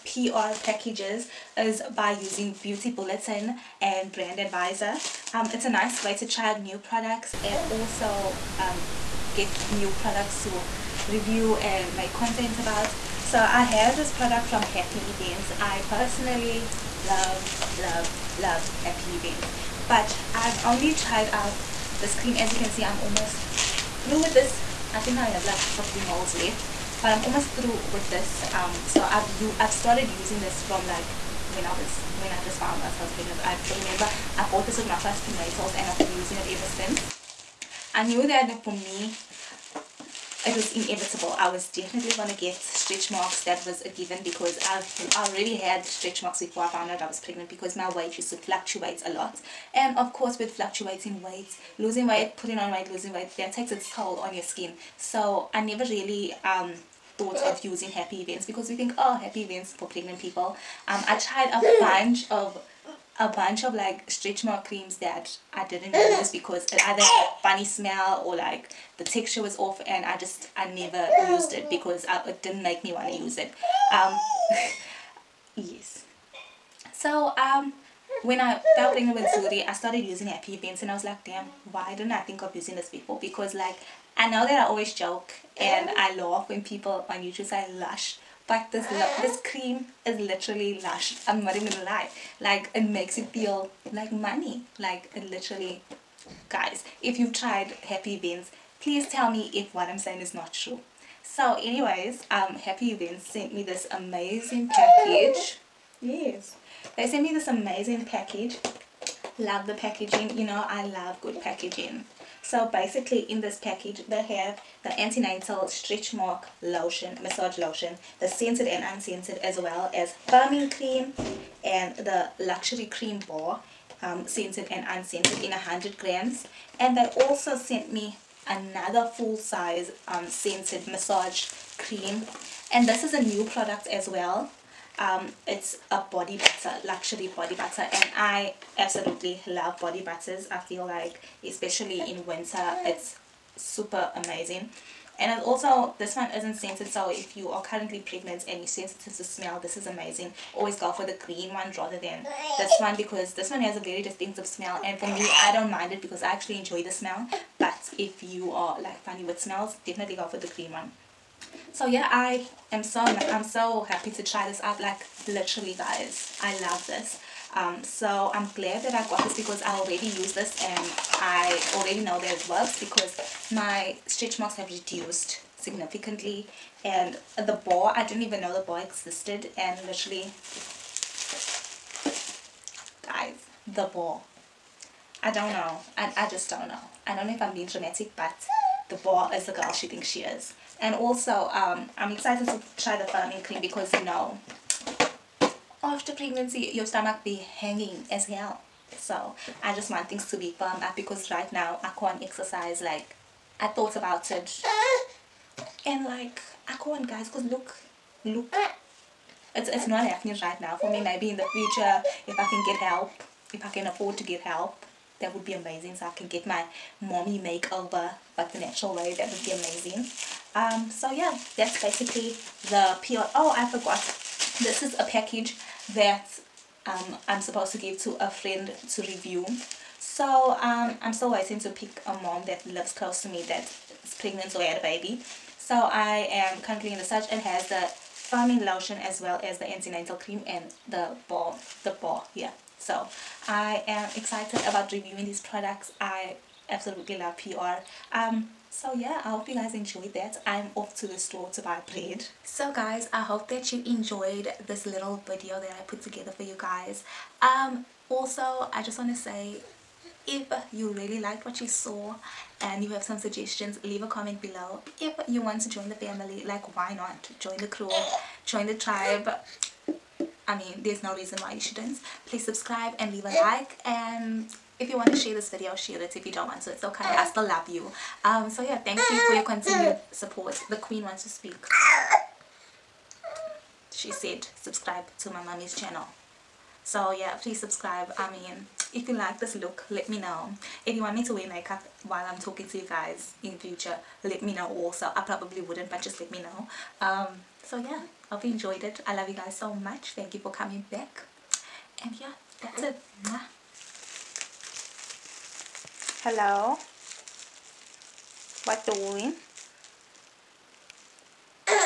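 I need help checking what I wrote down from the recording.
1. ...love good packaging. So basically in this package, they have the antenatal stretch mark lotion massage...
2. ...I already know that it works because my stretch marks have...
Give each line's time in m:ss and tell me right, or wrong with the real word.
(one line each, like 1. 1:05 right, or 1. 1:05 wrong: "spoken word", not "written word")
1. 1:50 right
2. 2:51 right.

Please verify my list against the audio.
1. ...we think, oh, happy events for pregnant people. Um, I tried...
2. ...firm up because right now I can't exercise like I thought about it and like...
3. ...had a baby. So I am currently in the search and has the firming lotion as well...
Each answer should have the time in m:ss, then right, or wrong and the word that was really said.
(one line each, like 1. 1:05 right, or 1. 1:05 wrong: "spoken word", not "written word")
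1. 0:58 right
2. 3:20 right
3. 3:54 right.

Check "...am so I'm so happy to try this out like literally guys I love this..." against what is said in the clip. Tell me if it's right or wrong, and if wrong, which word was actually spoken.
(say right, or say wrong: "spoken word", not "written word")
right.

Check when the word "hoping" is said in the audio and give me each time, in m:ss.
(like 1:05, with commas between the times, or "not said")
not said.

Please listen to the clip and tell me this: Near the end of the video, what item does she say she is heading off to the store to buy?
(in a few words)
Bread.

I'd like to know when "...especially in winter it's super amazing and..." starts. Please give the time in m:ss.
2:21.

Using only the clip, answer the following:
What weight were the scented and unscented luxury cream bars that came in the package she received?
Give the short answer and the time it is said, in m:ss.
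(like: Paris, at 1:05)
100 grams, at 2:05.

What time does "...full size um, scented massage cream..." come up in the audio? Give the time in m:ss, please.
2:09.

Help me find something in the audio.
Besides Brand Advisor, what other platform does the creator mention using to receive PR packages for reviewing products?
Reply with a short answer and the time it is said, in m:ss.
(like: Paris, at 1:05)
Beauty Bulletin, at 0:02.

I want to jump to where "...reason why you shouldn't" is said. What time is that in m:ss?
4:31.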